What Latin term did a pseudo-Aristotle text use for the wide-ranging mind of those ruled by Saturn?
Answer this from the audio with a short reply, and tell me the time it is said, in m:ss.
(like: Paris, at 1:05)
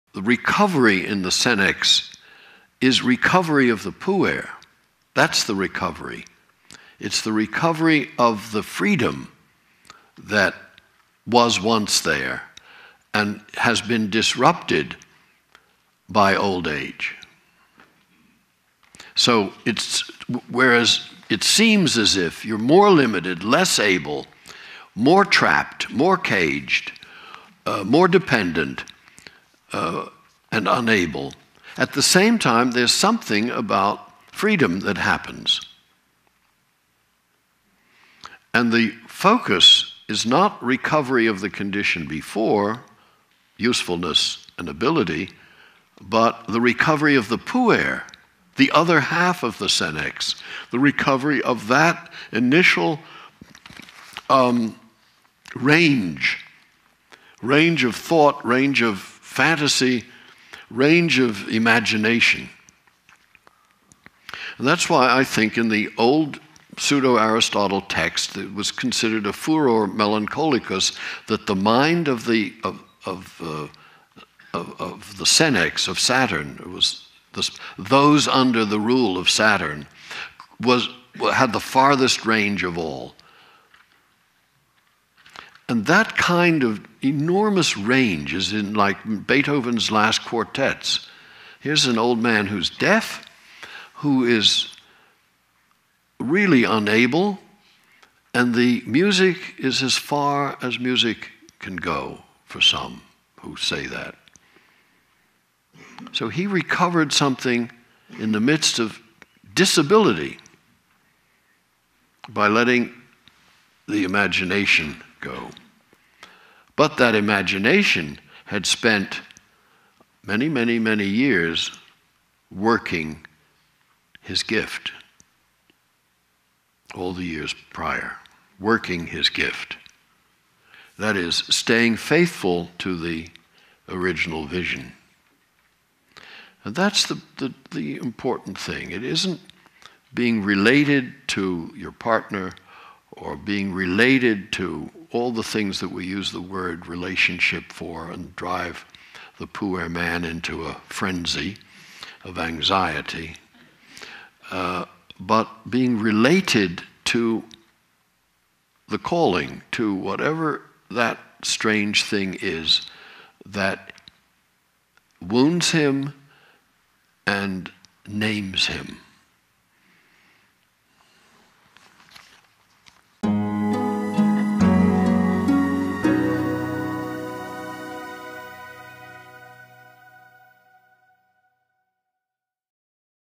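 furor melancholicus, at 1:09.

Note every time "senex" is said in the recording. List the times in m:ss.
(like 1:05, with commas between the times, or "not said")
0:01, 0:49, 1:15.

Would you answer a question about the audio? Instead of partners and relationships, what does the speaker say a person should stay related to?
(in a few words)
the calling.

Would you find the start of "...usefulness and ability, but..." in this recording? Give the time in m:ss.
0:43.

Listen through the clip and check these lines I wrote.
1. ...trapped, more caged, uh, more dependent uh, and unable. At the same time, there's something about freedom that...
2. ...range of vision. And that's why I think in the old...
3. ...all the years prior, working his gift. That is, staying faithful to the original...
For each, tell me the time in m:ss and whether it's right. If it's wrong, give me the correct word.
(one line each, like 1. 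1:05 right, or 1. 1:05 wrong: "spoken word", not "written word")
1. 0:25 right
2. 1:00 wrong: "imagination", not "vision"
3. 2:06 right.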